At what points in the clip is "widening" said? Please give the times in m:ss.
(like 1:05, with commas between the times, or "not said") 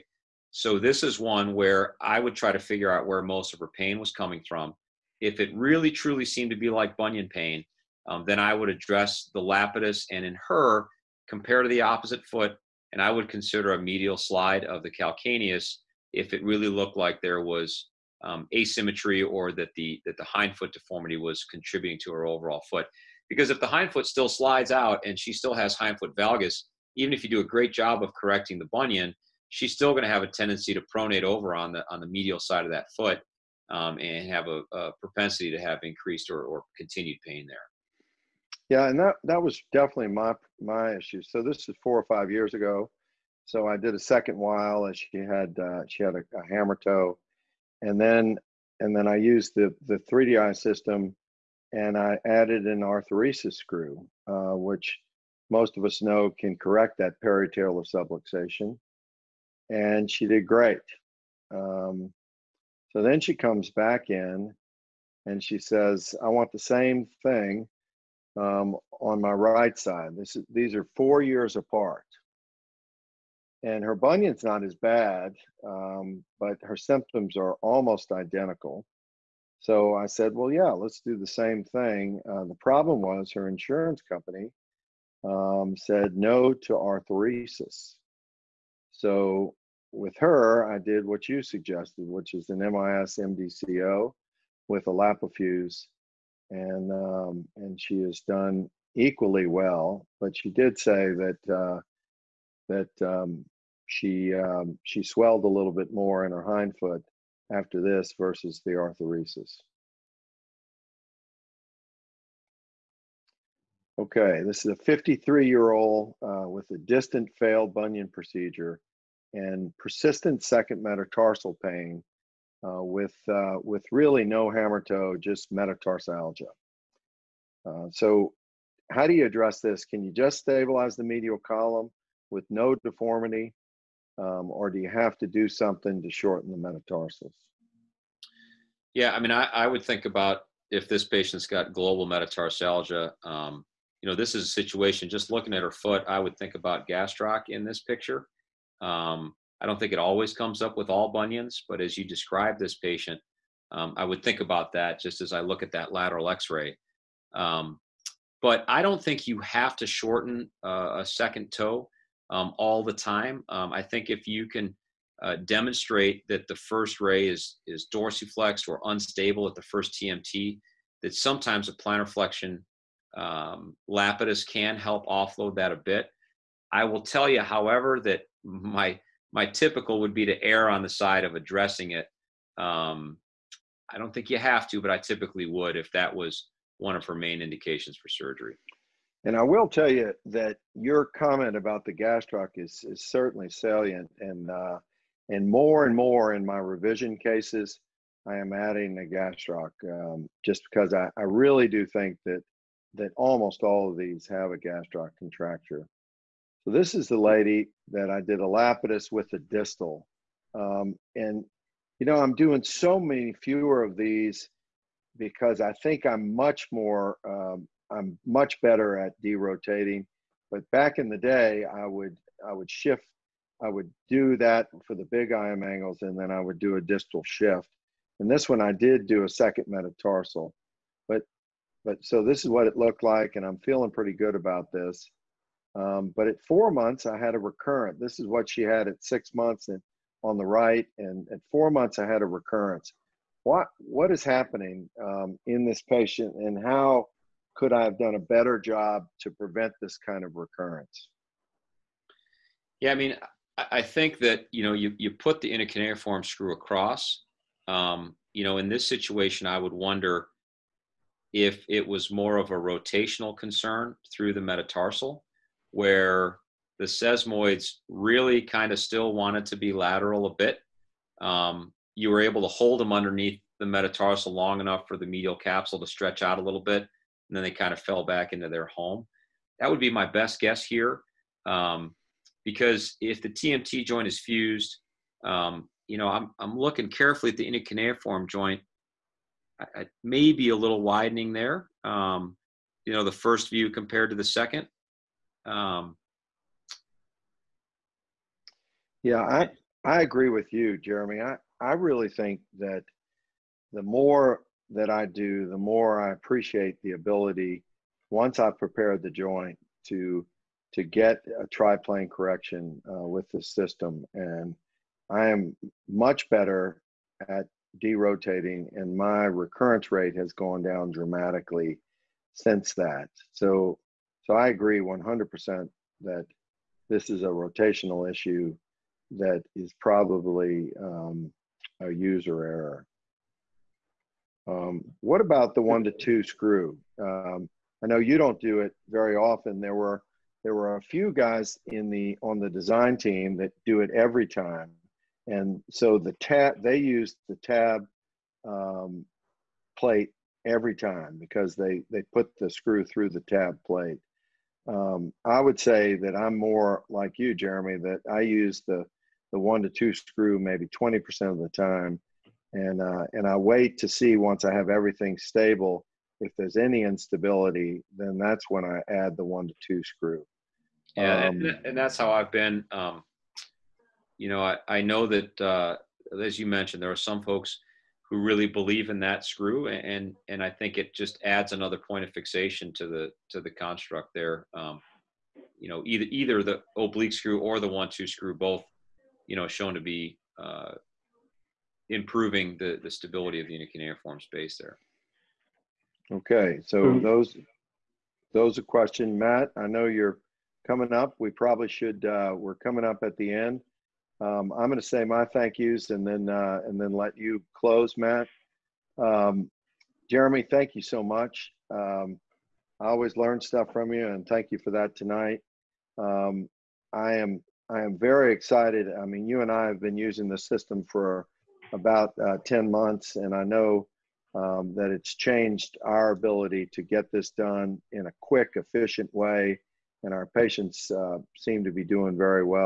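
4:50.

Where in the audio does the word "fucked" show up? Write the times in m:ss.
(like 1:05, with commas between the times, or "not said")
not said.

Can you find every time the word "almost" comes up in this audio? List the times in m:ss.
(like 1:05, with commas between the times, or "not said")
1:17, 3:23.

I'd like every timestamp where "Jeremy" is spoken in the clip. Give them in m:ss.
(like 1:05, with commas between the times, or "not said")
5:00, 5:57, 6:50.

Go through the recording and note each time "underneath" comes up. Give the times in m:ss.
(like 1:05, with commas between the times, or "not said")
4:32.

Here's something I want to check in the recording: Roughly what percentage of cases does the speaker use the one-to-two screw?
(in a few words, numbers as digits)
20%.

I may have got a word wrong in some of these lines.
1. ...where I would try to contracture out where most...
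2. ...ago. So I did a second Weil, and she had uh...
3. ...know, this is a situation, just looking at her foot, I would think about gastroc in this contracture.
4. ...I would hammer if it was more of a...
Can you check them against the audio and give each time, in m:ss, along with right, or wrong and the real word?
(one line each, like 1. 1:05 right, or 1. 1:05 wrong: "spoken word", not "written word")
1. 0:01 wrong: "figure", not "contracture"
2. 0:42 right
3. 2:24 wrong: "picture", not "contracture"
4. 4:19 wrong: "wonder", not "hammer".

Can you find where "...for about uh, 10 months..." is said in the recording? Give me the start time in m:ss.
7:00.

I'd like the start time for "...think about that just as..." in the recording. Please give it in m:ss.
2:34.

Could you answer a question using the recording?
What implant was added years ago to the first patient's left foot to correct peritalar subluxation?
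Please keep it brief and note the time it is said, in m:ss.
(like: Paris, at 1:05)
arthroereisis screw, at 0:52.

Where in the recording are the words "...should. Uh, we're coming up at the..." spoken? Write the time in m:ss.
6:41.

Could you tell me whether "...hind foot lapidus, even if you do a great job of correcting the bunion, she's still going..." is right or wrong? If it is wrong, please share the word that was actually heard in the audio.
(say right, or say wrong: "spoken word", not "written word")
wrong: "valgus", not "lapidus".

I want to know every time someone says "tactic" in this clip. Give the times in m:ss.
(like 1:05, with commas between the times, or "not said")
not said.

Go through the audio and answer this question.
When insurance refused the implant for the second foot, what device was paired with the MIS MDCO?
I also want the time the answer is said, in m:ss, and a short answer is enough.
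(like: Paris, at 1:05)
LapiFuse, at 1:34.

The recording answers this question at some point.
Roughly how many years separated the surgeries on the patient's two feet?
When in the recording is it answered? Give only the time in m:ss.
1:10.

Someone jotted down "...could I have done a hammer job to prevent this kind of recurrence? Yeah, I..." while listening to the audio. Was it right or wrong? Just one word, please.
wrong.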